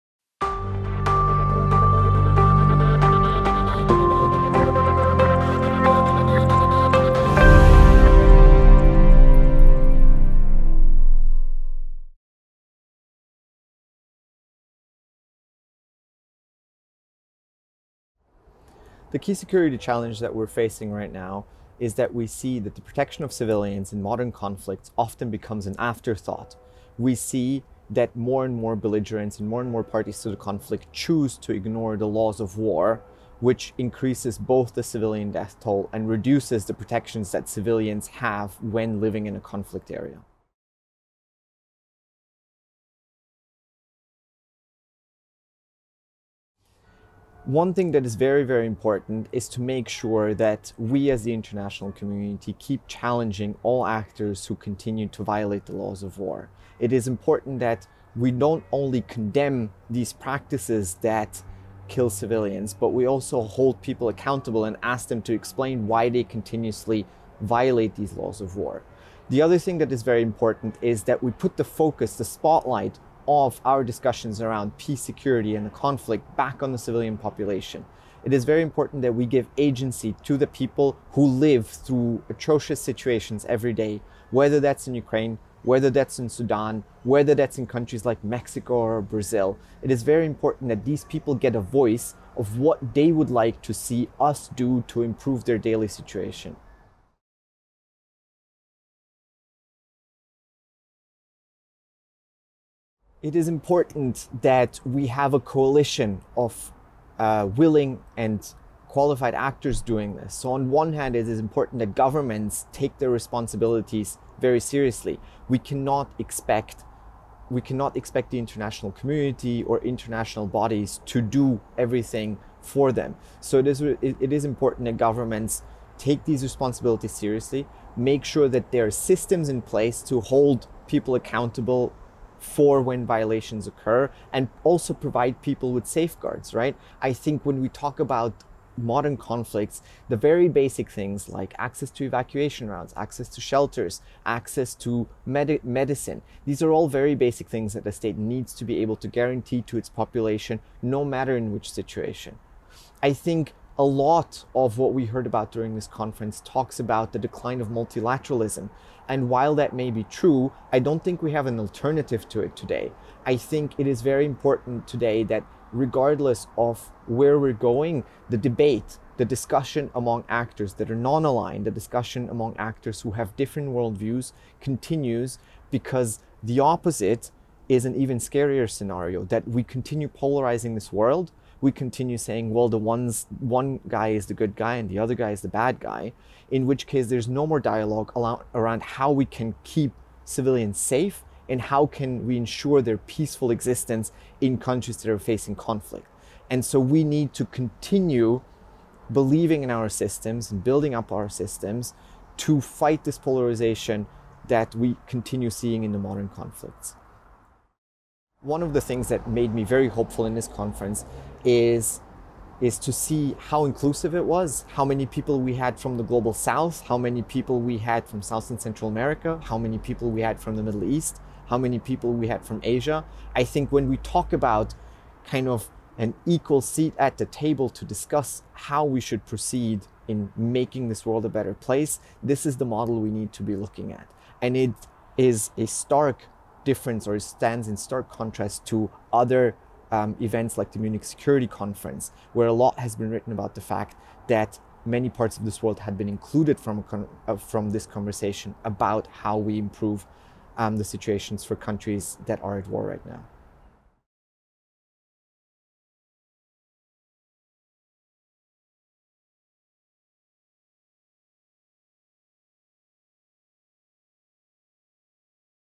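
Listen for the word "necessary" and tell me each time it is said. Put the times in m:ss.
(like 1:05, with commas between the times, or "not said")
not said.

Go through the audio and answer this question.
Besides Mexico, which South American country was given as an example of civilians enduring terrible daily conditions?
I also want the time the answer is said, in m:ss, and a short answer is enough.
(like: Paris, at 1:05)
Brazil, at 1:29.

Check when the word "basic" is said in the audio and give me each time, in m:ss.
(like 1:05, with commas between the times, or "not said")
2:20, 2:27.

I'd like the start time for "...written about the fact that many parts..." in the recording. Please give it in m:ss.
4:03.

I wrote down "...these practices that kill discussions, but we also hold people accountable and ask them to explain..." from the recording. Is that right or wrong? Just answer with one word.
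wrong.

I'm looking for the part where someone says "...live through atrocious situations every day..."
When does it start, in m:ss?
1:21.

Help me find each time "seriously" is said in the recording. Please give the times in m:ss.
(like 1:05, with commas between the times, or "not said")
1:54, 2:07.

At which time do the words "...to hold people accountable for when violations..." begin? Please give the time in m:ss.
2:10.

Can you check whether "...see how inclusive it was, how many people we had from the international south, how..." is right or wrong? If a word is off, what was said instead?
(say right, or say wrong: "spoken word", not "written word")
wrong: "global", not "international".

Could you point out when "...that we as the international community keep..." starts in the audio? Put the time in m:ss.
0:50.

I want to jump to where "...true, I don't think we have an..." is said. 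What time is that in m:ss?
2:40.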